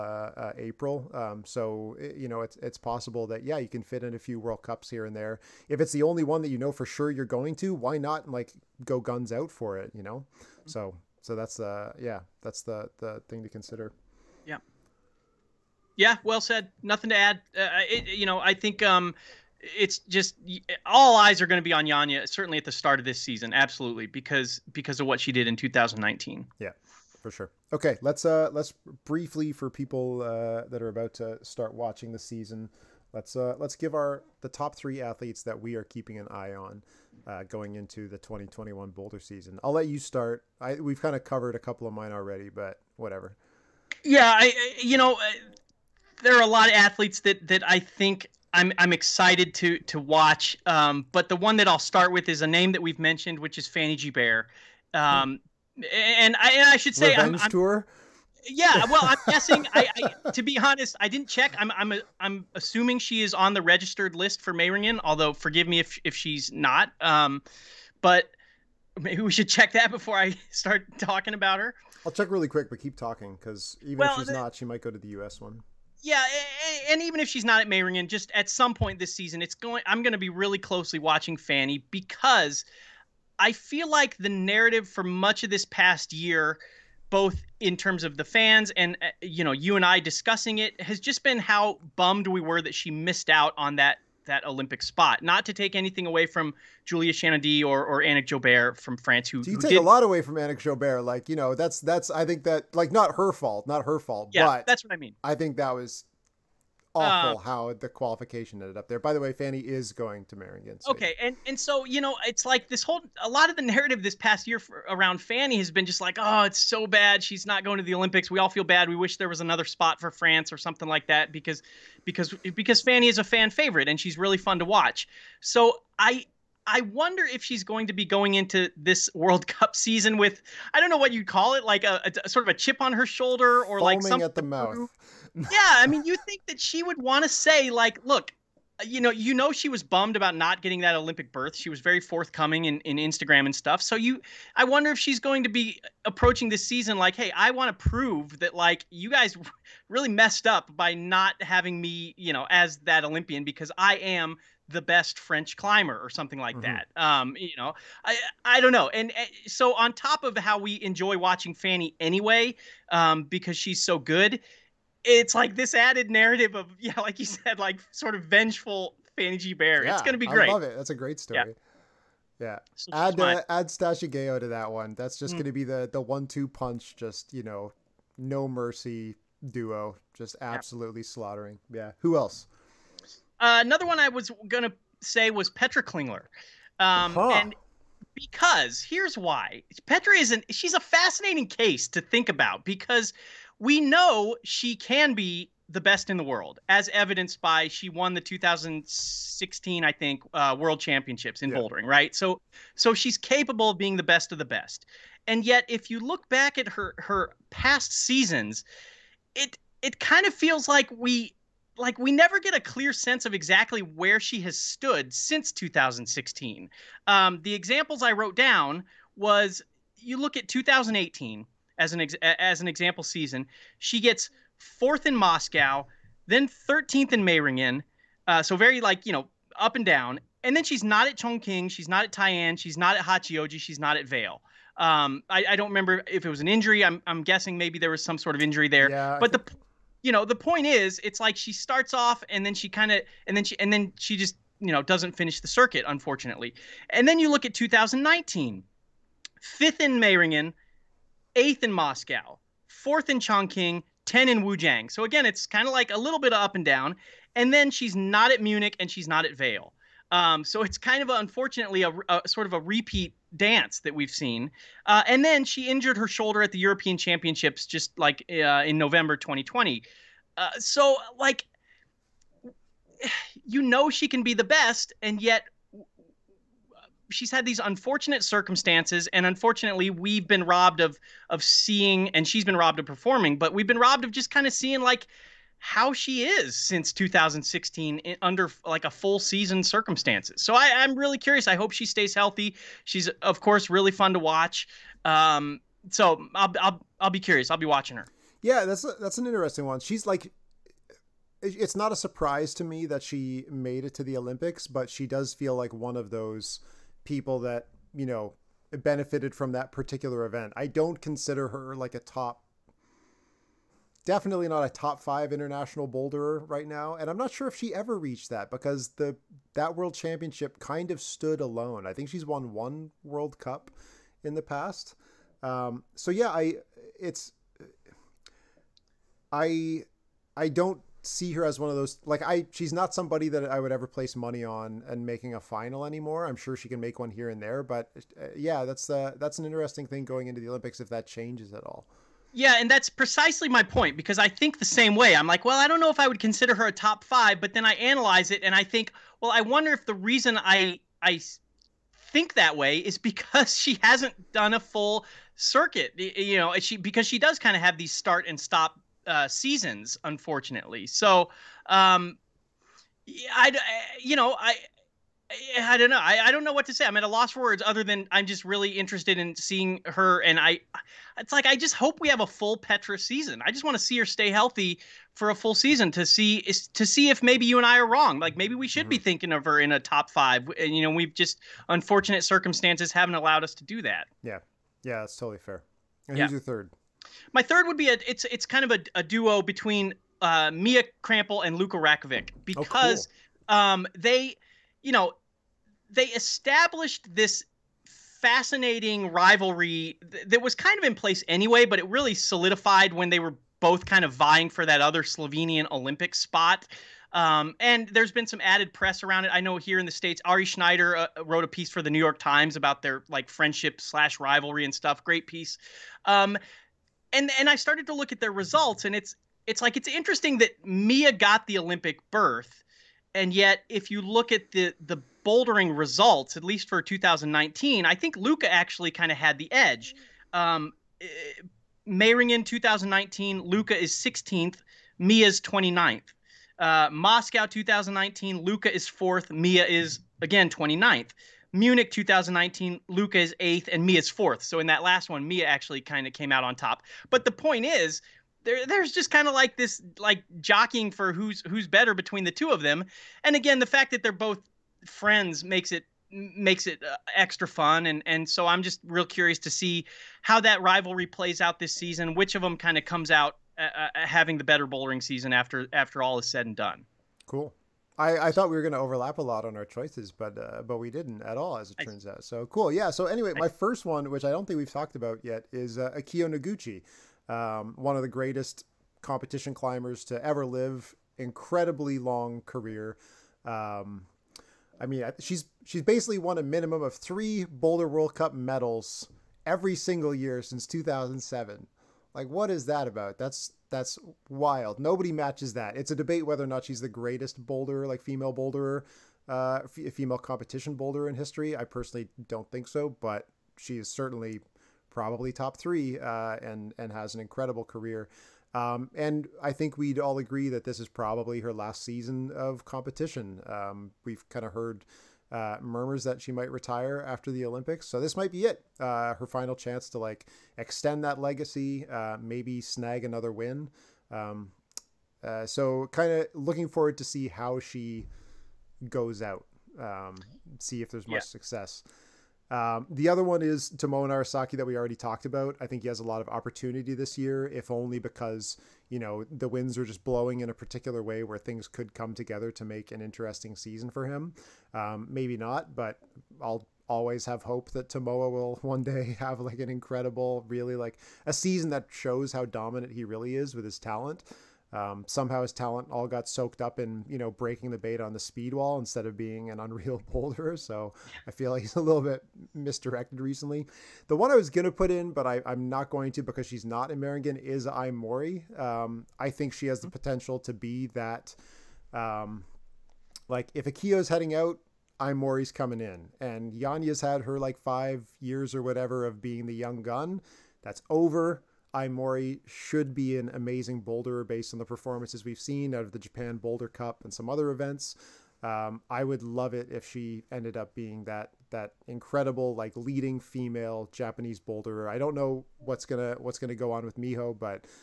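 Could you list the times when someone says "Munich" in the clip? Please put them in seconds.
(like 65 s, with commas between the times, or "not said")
258 s, 441 s.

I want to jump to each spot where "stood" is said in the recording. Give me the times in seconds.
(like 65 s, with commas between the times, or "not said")
214 s, 321 s.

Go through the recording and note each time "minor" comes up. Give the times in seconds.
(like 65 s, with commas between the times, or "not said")
not said.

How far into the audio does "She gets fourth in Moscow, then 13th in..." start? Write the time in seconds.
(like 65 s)
223 s.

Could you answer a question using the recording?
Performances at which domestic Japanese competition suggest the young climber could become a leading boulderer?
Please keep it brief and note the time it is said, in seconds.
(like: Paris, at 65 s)
Japan Boulder Cup, at 585 s.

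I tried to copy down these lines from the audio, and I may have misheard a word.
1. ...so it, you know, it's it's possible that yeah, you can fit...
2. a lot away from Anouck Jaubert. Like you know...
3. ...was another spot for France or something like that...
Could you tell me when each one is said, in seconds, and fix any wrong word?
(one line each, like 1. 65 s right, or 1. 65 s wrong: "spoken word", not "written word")
1. 1 s right
2. 99 s right
3. 119 s right.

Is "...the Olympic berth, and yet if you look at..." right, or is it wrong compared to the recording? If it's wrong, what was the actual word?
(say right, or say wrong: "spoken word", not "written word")
right.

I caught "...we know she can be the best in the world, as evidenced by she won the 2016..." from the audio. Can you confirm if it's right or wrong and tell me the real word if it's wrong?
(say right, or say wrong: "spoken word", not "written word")
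right.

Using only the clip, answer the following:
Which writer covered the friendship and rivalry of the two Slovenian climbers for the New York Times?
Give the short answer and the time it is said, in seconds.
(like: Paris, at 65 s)
Ari Schneider, at 410 s.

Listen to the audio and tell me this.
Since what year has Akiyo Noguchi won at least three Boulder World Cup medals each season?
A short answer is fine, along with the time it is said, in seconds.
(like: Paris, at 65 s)
2007, at 490 s.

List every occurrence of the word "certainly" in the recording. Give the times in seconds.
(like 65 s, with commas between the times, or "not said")
22 s, 503 s.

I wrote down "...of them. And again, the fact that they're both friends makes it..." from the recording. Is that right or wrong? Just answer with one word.
right.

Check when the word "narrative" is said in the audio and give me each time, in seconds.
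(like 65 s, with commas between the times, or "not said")
84 s, 113 s, 166 s.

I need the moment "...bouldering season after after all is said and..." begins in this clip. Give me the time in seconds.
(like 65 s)
464 s.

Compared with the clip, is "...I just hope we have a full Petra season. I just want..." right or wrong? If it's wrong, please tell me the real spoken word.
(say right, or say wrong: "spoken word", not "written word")
right.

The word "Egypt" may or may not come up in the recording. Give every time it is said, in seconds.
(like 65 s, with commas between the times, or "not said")
not said.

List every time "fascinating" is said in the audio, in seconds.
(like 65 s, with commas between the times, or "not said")
190 s, 398 s.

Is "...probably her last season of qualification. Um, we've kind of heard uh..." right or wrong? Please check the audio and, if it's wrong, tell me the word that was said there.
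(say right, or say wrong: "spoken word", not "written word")
wrong: "competition", not "qualification".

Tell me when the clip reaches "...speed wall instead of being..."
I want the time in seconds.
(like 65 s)
558 s.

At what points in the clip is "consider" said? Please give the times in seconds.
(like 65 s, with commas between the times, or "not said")
13 s, 311 s, 346 s.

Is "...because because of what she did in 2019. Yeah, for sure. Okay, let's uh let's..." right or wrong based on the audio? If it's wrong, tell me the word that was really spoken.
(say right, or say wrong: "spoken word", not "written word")
right.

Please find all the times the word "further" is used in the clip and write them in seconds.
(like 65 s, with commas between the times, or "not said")
not said.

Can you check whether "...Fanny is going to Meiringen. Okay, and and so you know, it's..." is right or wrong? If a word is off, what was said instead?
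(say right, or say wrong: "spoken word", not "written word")
right.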